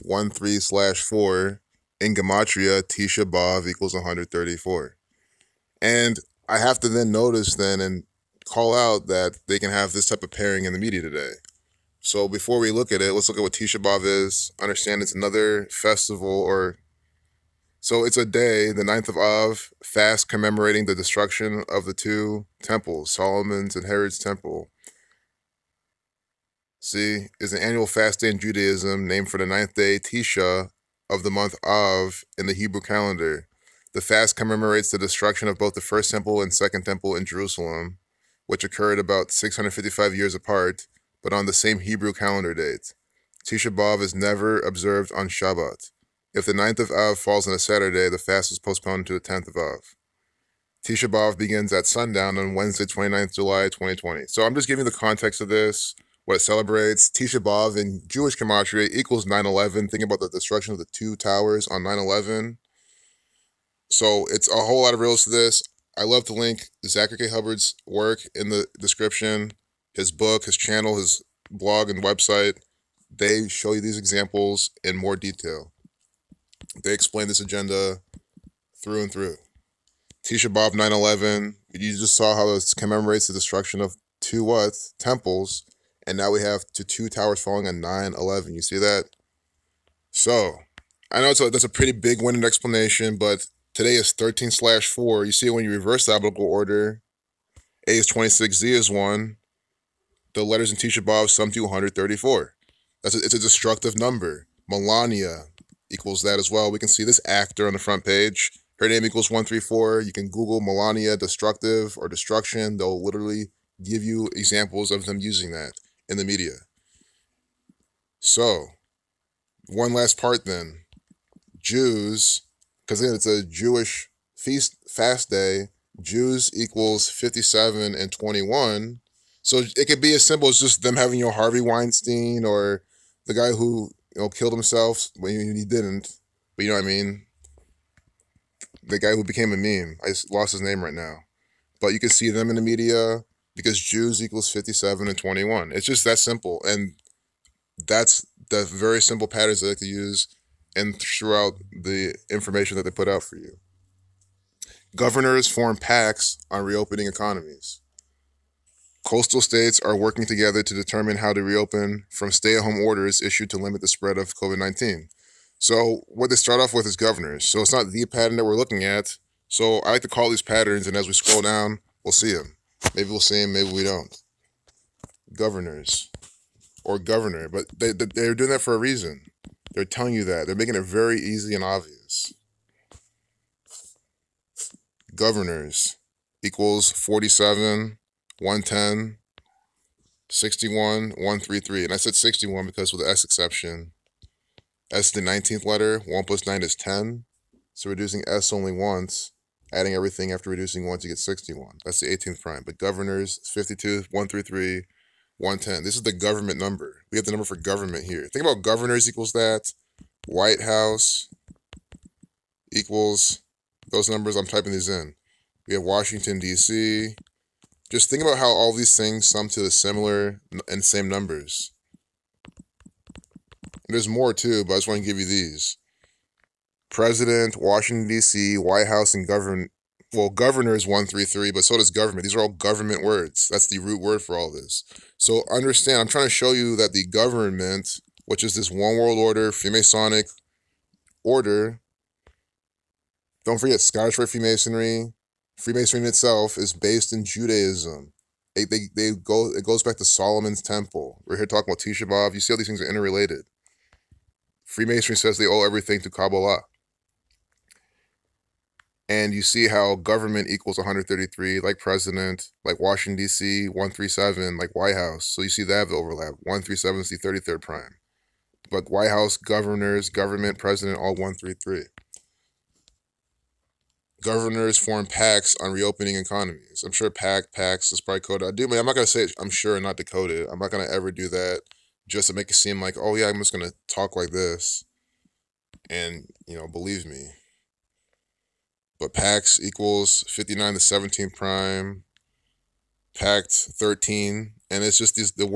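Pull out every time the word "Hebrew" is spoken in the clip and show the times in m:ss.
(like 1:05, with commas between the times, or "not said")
0:32, 0:41.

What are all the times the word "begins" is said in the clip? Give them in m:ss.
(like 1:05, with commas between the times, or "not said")
0:51.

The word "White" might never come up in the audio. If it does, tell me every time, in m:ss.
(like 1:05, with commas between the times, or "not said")
3:30, 3:48, 4:24, 4:28.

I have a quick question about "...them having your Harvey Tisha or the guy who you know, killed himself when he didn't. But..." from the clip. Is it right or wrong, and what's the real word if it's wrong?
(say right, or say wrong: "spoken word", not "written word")
wrong: "Weinstein", not "Tisha".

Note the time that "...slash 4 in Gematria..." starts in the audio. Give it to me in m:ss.
0:00.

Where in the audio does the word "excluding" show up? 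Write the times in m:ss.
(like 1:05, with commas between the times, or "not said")
not said.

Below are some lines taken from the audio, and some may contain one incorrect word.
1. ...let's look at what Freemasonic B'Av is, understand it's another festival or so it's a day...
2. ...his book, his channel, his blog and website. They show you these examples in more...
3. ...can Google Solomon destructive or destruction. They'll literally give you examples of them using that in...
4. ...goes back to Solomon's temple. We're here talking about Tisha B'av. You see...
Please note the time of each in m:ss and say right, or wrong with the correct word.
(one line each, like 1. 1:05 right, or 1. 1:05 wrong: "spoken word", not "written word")
1. 0:13 wrong: "Tisha", not "Freemasonic"
2. 1:09 right
3. 1:50 wrong: "Melania", not "Solomon"
4. 4:09 right.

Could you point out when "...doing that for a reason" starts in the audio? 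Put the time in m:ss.
2:58.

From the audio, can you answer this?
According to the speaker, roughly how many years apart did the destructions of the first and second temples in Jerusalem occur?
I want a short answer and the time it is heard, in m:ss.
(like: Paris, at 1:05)
655, at 0:39.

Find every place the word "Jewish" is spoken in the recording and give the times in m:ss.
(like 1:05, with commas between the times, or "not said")
0:58, 2:03.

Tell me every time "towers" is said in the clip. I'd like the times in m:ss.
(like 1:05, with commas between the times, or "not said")
1:01, 1:27.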